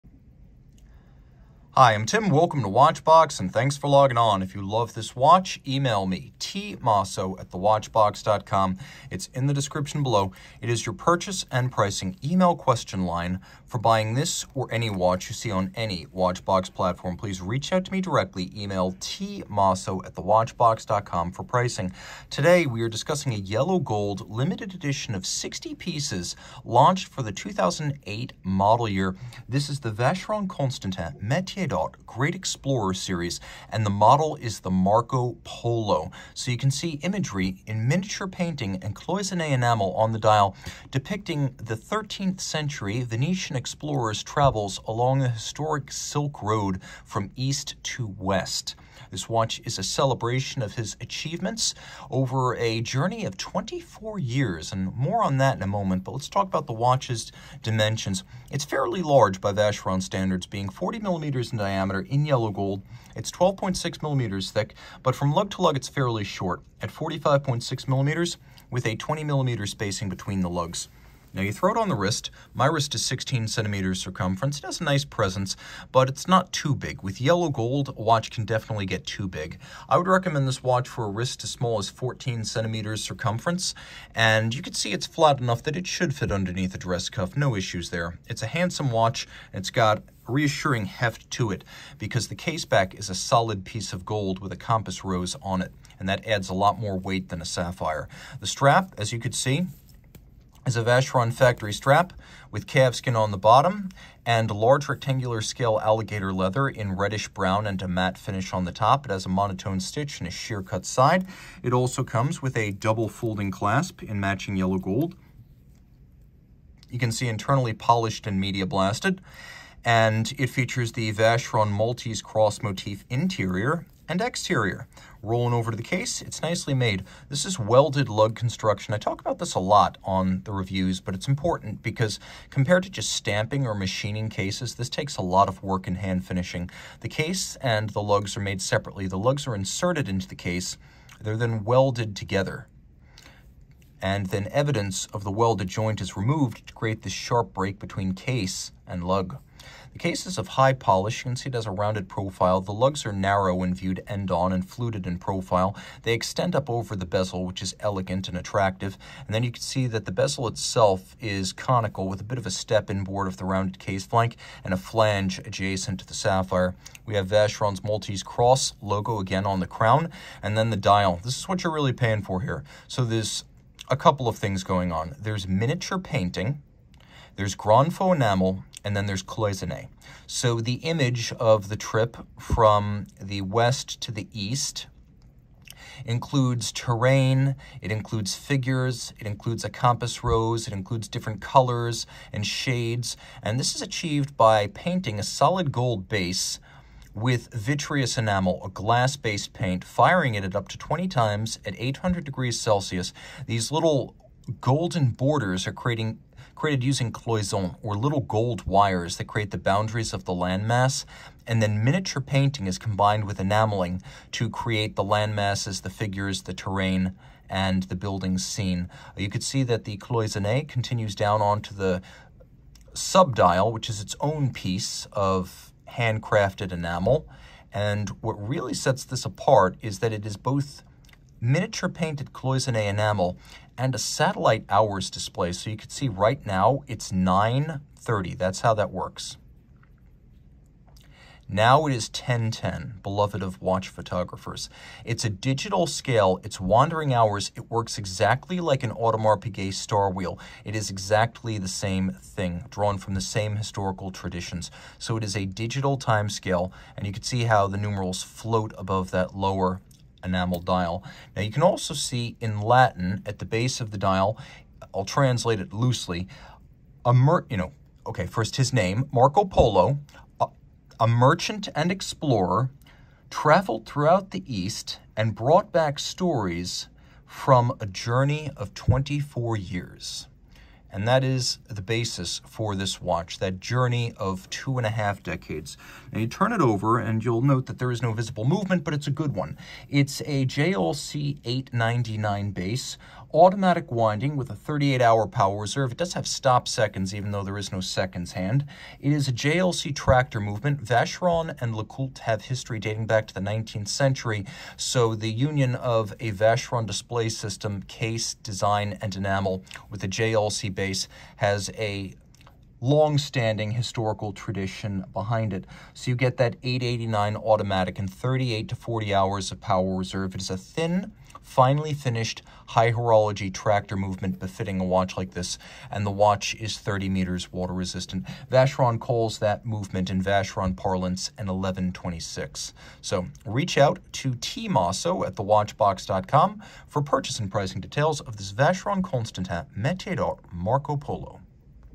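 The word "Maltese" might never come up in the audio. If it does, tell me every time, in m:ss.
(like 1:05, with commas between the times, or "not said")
2:01, 2:47.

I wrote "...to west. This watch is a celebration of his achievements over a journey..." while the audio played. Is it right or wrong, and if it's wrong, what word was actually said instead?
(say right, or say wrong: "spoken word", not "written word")
right.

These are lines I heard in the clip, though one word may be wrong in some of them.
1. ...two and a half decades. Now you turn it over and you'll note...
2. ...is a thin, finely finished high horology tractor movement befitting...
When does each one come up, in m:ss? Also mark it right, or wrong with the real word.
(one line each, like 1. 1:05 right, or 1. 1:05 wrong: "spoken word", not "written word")
1. 4:44 right
2. 5:20 right.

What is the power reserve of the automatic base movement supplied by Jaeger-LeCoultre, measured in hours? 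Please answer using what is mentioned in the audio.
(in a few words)
38 hours.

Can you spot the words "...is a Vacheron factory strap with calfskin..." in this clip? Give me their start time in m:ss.
1:40.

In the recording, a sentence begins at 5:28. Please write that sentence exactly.
Vacheron calls that movement in Vacheron parlance an 1126.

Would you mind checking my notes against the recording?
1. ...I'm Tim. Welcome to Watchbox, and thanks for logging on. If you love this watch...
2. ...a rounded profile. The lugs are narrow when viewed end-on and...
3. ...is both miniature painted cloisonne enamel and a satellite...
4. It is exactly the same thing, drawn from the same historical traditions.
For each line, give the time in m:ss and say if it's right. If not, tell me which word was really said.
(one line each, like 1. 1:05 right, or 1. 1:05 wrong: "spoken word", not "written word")
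1. 0:01 right
2. 2:31 right
3. 3:50 right
4. 4:10 right.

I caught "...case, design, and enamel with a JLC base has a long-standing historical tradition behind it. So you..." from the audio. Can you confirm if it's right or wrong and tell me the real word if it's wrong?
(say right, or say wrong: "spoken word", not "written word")
right.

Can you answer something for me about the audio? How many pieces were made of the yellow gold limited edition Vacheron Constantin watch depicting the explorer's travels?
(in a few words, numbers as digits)
60.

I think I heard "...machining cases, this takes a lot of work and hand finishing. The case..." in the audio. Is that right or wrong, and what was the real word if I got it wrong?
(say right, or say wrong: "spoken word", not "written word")
right.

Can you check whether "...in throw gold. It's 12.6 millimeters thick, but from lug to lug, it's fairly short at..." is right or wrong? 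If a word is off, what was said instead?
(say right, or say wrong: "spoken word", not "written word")
wrong: "yellow", not "throw".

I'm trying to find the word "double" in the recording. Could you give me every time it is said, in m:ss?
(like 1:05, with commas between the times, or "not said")
1:52.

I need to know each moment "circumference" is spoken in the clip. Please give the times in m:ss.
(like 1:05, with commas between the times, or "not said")
1:14, 1:23.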